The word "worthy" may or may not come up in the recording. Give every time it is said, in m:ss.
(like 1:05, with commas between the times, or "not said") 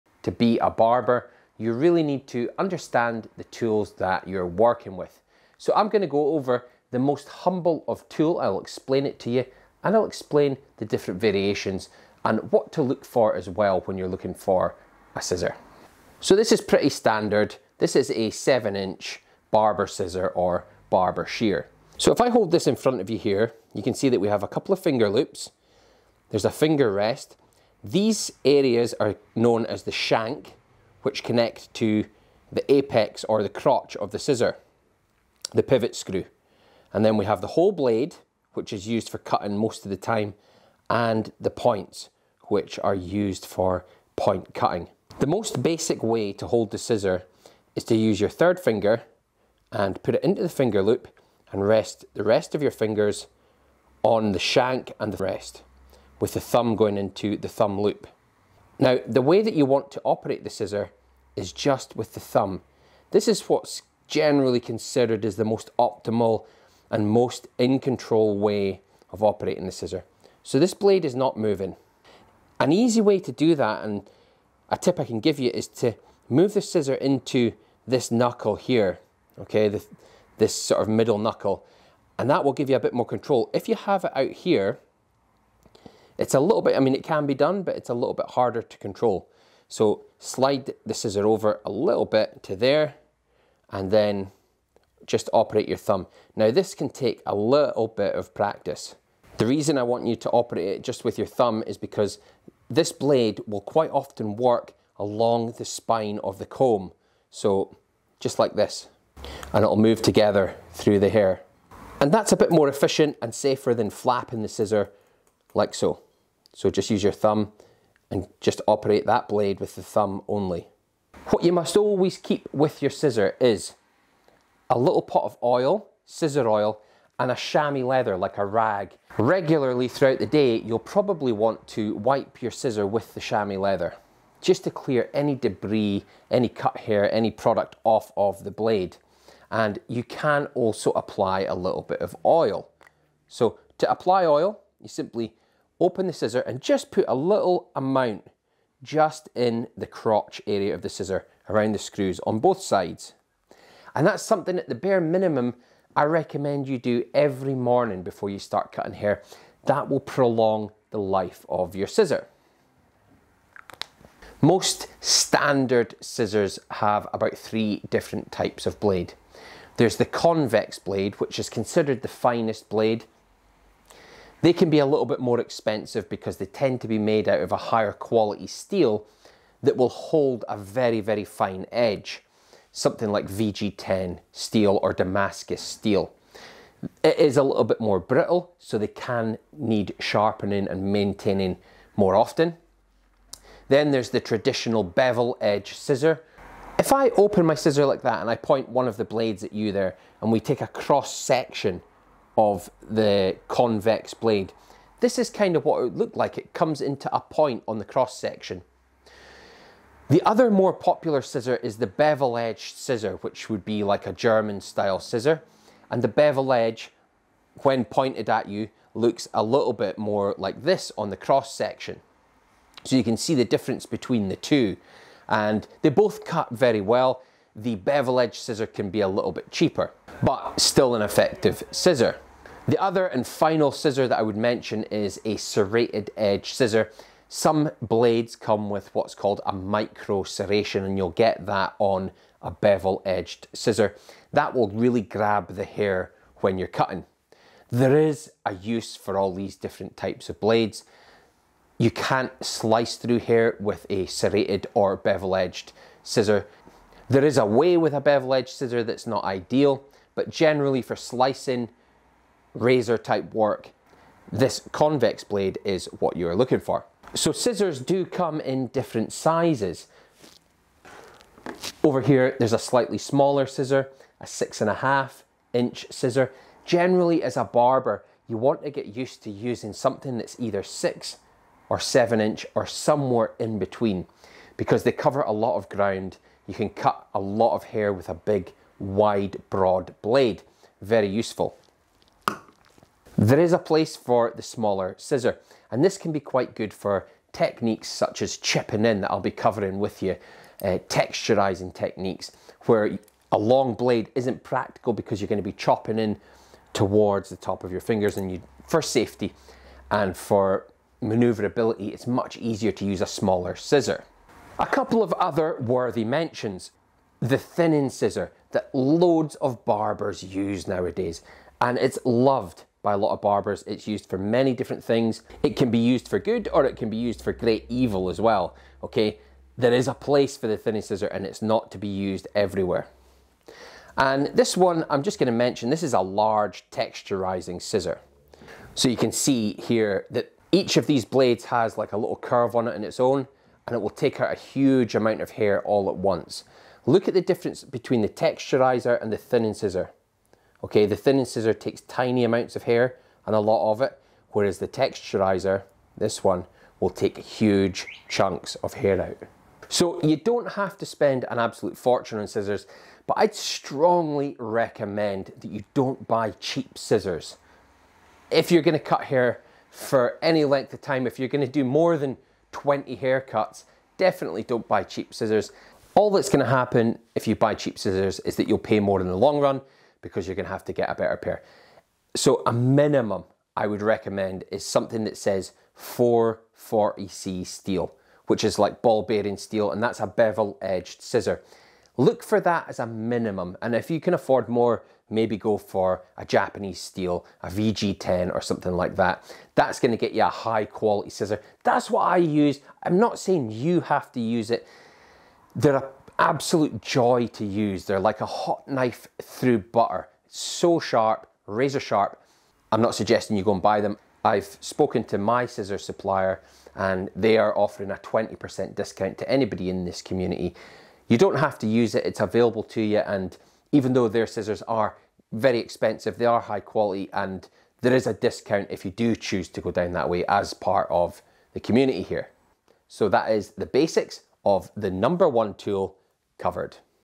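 5:15.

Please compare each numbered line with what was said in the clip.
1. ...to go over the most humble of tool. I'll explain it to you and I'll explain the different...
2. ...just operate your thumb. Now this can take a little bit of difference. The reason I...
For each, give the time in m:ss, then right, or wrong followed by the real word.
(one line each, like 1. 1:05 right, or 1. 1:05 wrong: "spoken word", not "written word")
1. 0:06 right
2. 1:35 wrong: "practice", not "difference".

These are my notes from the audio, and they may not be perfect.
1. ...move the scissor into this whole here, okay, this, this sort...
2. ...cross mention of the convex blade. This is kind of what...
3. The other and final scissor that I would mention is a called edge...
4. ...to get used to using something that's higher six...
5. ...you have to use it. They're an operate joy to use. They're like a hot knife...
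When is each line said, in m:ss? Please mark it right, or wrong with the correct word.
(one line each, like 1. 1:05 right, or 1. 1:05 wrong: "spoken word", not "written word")
1. 1:16 wrong: "knuckle", not "whole"
2. 3:20 wrong: "section", not "mention"
3. 3:52 wrong: "serrated", not "called"
4. 4:38 wrong: "either", not "higher"
5. 6:43 wrong: "absolute", not "operate".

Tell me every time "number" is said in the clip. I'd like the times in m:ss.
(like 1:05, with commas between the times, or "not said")
7:14.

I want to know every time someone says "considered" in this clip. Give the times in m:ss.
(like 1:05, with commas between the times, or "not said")
1:04, 2:51.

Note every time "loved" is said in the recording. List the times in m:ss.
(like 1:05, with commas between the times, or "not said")
5:22.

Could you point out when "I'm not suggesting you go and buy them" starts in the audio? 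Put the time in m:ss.
6:52.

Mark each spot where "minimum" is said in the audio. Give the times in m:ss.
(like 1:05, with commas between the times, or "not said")
2:35, 6:22, 6:32.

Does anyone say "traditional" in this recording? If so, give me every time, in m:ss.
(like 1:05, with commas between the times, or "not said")
3:14.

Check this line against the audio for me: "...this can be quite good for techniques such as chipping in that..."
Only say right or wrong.
right.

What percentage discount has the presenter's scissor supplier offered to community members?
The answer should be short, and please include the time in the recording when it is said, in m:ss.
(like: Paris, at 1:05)
20%, at 6:57.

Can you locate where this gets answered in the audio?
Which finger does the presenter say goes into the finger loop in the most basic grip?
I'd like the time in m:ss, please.
0:48.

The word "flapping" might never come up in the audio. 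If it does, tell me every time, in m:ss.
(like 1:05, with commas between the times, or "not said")
1:53.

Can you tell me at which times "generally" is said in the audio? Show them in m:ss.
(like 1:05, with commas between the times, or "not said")
1:04, 4:20, 4:36.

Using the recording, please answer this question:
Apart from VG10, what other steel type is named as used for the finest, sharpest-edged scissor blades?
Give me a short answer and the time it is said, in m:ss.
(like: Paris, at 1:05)
Damascus steel, at 3:04.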